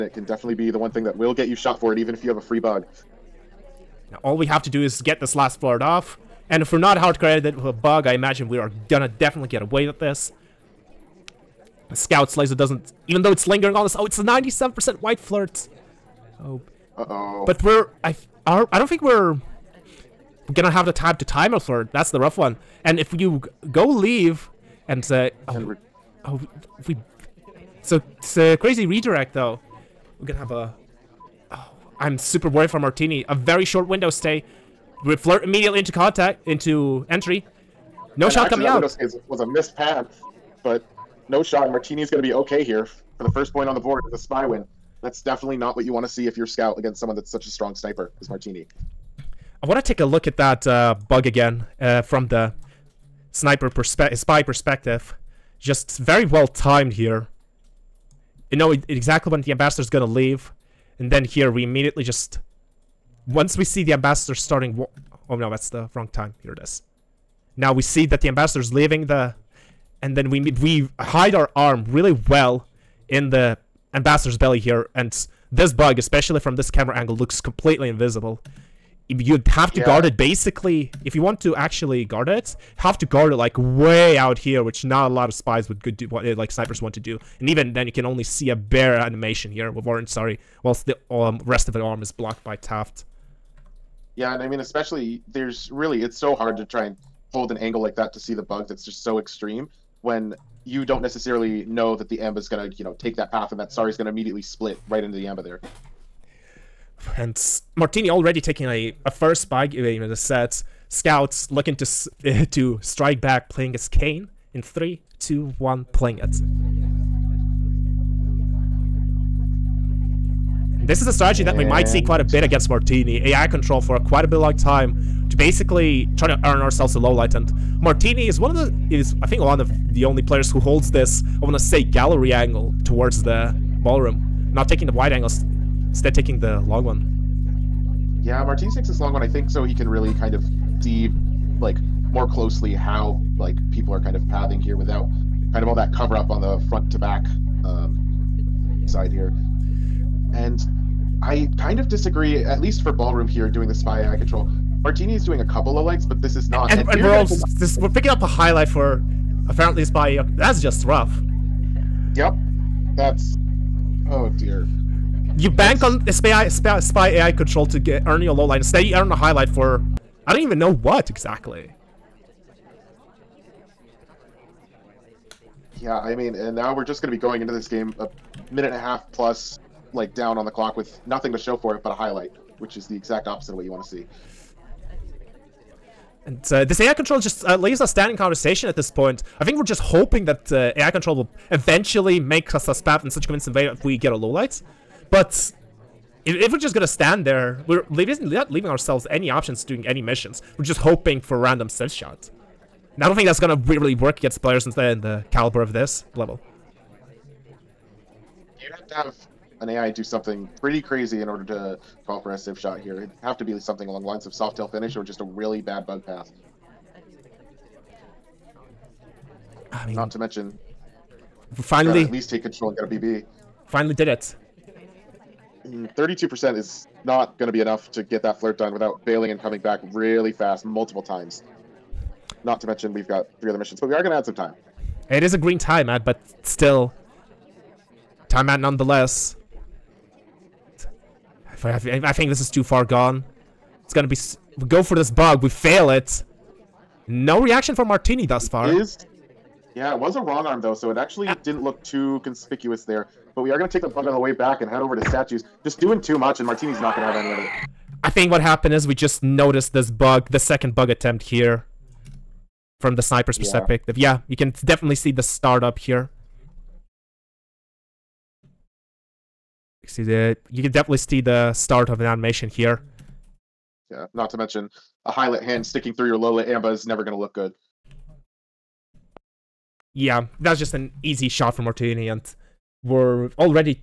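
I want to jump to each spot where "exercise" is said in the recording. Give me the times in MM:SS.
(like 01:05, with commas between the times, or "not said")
not said.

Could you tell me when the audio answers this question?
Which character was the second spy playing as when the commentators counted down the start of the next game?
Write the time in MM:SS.
01:53.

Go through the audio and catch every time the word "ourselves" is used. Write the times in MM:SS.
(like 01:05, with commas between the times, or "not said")
02:06, 03:18.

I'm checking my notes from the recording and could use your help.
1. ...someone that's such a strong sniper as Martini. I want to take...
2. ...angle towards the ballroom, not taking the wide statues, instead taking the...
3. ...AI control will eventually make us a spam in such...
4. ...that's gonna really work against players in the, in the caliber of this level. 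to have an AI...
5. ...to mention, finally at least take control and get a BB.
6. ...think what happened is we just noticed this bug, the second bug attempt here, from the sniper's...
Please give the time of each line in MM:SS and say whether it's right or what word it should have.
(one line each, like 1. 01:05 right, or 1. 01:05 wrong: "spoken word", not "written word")
1. 00:46 right
2. 02:12 wrong: "angles", not "statues"
3. 03:10 right
4. 03:23 right
5. 03:40 right
6. 04:18 right.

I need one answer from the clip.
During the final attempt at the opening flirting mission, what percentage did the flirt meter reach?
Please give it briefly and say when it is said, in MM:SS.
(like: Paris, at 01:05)
97%, at 00:14.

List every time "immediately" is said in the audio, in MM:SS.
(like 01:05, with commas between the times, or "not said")
00:35, 01:01, 01:44.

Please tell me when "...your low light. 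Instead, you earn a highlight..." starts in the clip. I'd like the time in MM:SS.
02:48.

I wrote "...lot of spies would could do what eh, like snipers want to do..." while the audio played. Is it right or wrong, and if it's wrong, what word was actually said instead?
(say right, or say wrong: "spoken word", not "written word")
right.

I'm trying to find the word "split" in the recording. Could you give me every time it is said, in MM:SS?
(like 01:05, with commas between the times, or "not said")
01:44.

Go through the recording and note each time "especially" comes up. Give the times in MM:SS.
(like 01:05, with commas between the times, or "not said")
01:15, 01:34.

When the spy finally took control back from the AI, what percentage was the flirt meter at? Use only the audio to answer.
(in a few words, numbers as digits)
32%.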